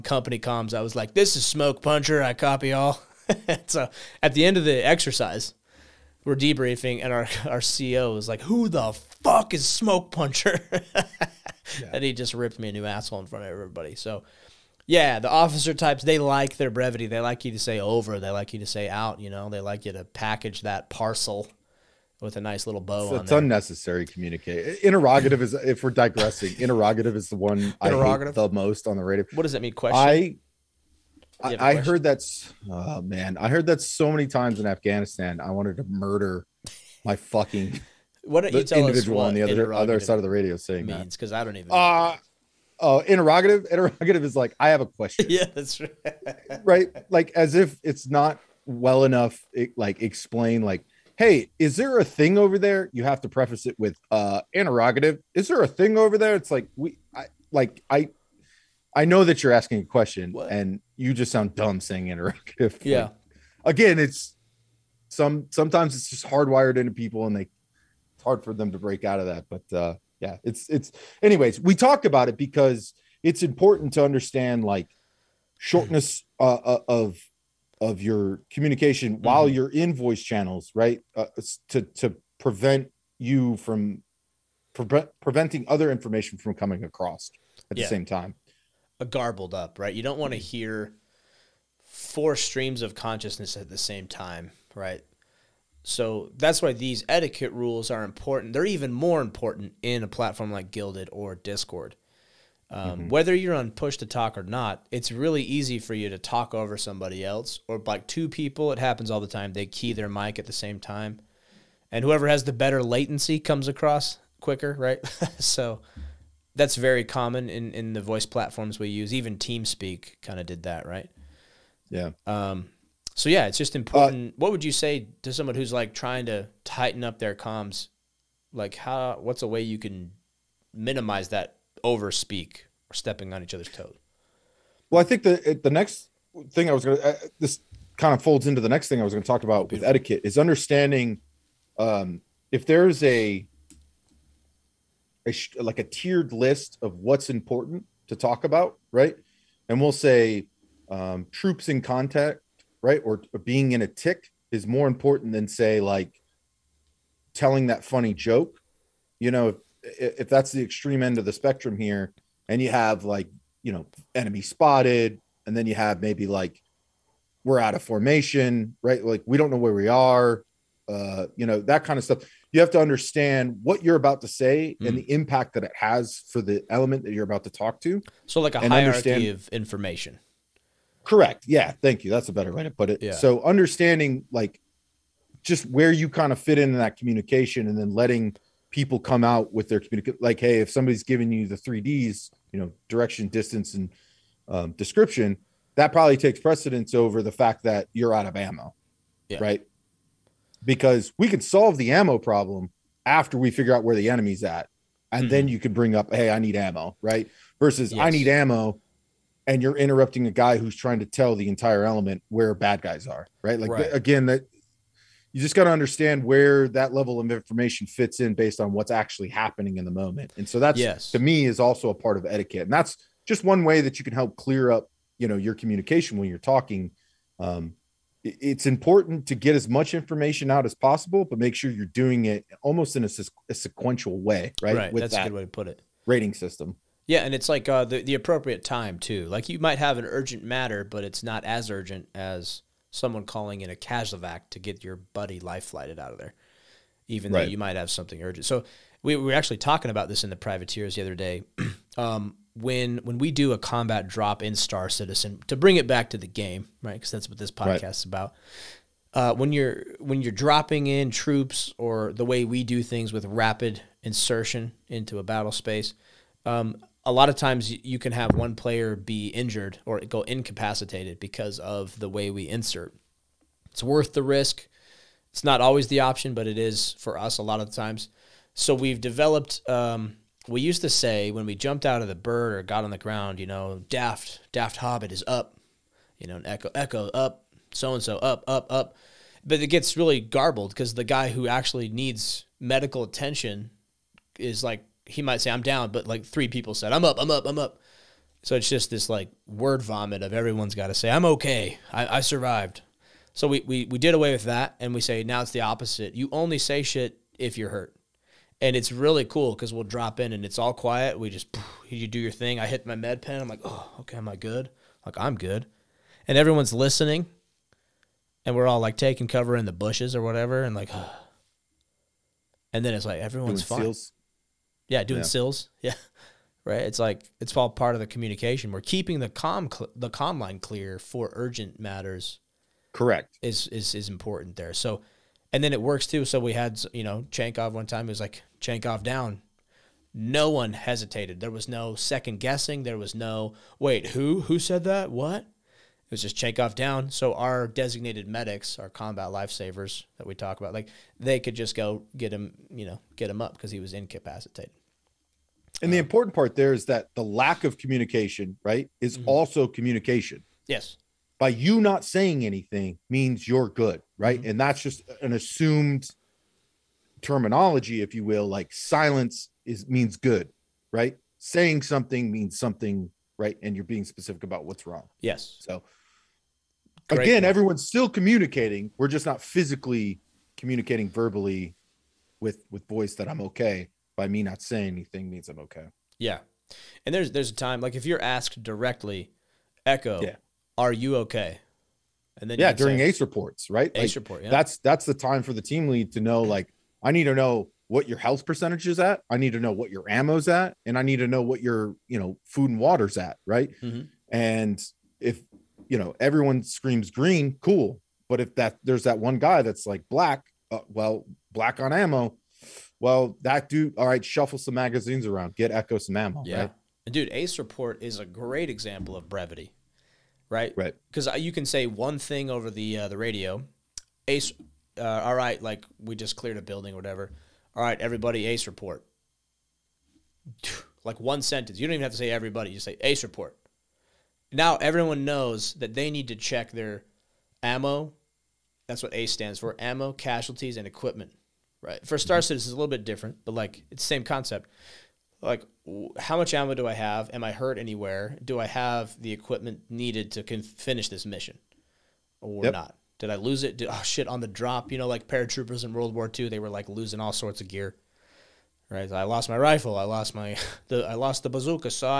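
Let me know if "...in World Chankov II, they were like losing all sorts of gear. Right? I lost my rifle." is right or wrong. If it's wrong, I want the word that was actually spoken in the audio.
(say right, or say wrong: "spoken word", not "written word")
wrong: "War", not "Chankov".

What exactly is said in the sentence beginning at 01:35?
So that's why these etiquette rules are important.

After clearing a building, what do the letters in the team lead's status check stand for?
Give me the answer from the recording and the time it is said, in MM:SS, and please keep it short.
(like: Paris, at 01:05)
ammo, casualties, and equipment, at 07:19.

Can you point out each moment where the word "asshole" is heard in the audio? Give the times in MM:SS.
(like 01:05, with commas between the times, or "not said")
00:12.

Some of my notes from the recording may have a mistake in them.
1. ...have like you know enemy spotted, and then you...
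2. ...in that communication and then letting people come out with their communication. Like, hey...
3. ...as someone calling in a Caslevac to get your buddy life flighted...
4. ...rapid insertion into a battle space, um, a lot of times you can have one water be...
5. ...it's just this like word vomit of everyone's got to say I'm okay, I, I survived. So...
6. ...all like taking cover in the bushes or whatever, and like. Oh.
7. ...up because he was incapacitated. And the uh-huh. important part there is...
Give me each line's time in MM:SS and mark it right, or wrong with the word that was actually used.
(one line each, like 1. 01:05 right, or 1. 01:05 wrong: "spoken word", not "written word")
1. 02:42 right
2. 03:06 right
3. 04:02 right
4. 04:23 wrong: "player", not "water"
5. 04:58 right
6. 05:18 right
7. 05:53 right.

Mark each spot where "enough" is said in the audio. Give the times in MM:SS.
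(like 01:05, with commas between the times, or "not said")
00:49.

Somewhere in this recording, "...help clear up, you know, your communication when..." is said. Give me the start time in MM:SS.
03:44.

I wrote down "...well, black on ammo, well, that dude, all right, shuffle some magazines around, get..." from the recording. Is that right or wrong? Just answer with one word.
right.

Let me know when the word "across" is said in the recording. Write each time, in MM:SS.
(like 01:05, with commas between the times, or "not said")
01:26, 01:53.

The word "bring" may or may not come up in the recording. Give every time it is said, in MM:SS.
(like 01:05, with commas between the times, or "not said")
03:25, 04:15.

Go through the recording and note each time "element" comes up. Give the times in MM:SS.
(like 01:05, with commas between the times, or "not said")
02:56, 03:31.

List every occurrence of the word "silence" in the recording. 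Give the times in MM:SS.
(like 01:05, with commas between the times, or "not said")
06:08.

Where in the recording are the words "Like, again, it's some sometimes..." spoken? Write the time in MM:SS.
01:03.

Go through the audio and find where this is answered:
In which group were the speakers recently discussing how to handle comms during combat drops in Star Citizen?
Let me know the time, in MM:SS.
04:10.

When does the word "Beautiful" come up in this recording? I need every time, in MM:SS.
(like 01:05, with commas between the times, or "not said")
02:19.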